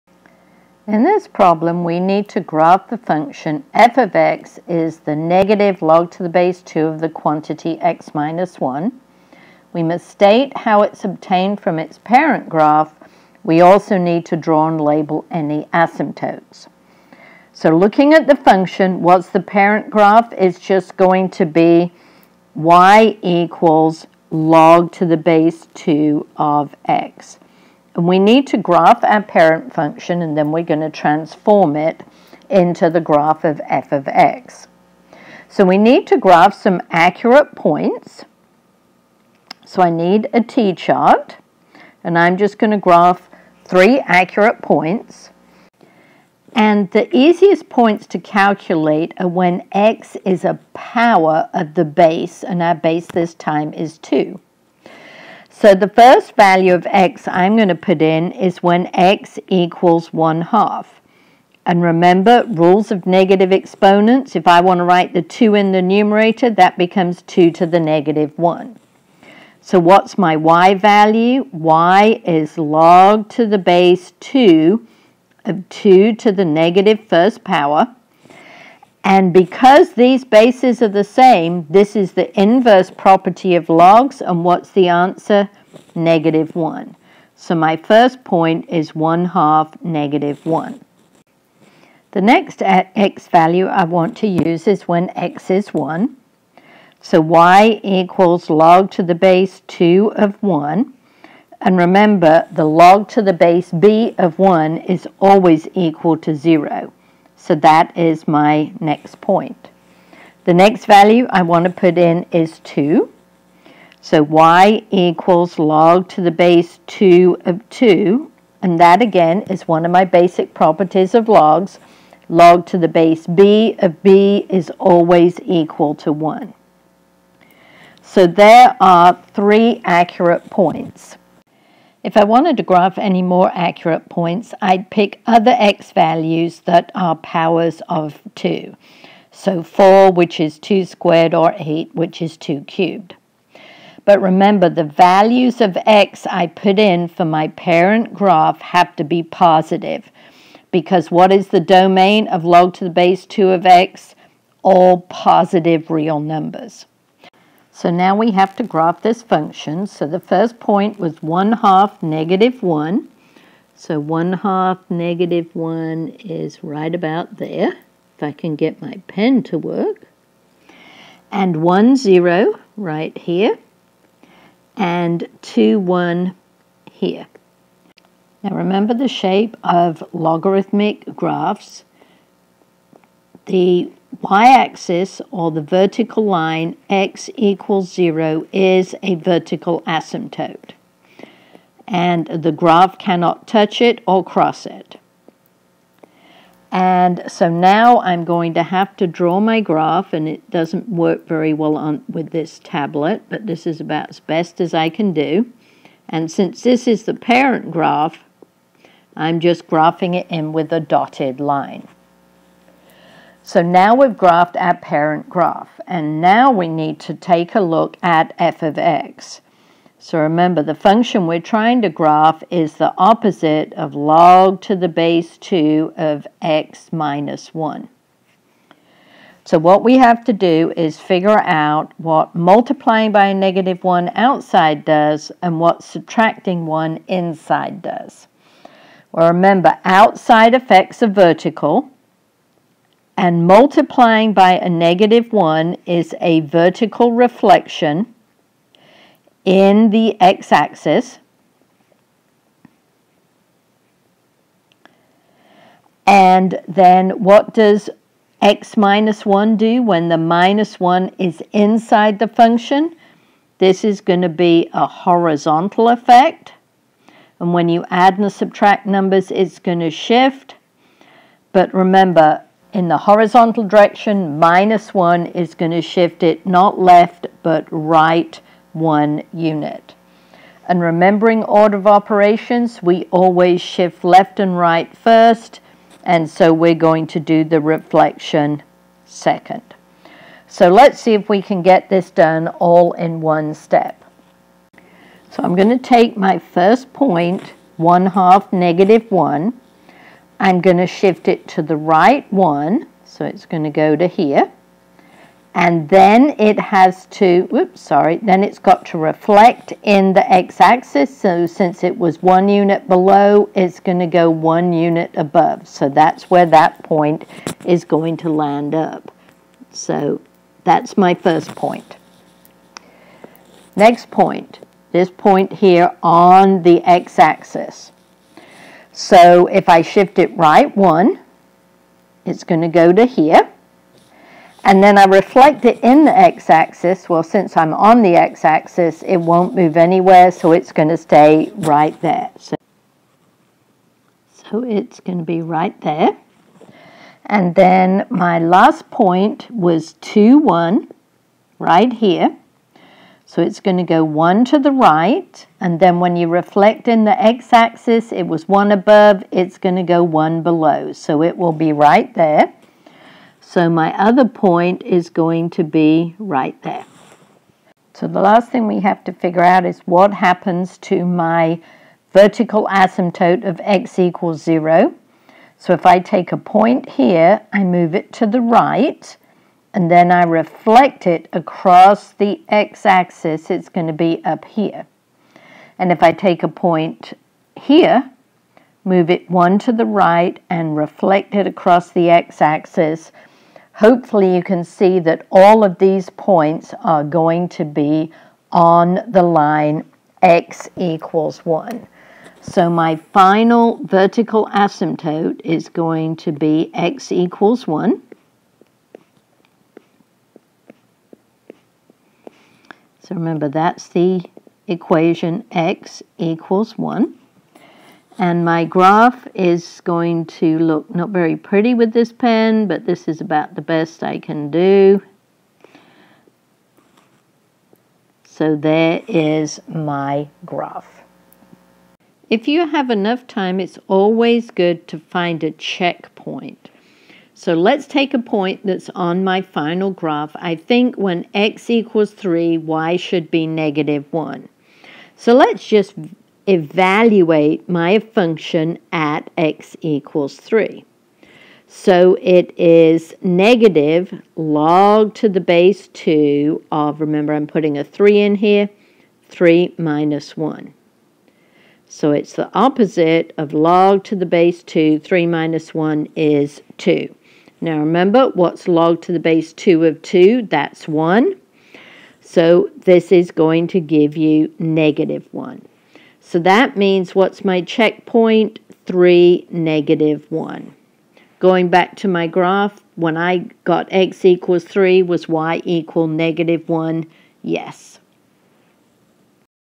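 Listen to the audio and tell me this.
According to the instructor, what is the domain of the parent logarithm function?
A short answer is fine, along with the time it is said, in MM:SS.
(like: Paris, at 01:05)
All positive real numbers, at 02:34.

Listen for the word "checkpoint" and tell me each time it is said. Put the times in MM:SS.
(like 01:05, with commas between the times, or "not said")
07:15, 07:57.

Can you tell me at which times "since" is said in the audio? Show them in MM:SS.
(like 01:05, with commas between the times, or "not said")
03:26, 05:11, 05:37.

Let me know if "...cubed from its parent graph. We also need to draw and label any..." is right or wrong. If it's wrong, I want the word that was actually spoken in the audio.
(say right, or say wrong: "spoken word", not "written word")
wrong: "obtained", not "cubed".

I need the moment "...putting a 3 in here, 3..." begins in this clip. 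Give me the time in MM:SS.
07:37.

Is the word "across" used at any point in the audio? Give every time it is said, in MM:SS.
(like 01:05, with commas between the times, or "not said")
06:21, 06:31.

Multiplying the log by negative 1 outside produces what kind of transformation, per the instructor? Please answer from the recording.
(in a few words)
vertical reflection in the x-axis.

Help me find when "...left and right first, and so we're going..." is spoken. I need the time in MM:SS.
04:44.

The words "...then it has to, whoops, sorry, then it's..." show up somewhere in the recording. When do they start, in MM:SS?
05:05.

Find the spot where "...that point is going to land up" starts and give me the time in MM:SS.
05:16.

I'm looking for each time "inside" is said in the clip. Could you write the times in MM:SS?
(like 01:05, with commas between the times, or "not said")
03:57, 04:21.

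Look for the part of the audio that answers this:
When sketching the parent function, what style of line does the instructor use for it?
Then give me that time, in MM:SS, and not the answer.
03:30.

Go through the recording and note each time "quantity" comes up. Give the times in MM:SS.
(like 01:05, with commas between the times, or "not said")
00:07.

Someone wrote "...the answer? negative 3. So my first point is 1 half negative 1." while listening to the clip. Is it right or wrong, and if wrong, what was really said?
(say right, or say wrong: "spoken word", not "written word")
wrong: "1", not "3".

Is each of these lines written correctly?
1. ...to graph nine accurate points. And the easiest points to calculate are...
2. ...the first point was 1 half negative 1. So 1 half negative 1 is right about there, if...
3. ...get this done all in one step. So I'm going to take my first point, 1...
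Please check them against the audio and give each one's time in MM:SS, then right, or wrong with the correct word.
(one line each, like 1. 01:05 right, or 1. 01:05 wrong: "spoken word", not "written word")
1. 00:42 wrong: "three", not "nine"
2. 02:40 right
3. 04:51 right.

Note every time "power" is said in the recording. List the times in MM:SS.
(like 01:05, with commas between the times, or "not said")
00:50, 01:17, 02:17.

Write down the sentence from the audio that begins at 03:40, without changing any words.
So remember, the function we're trying to graph is the opposite of log to the base 2 of x minus 1.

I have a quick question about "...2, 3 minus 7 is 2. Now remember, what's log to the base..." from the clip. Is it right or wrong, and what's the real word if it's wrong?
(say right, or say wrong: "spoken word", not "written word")
wrong: "1", not "7".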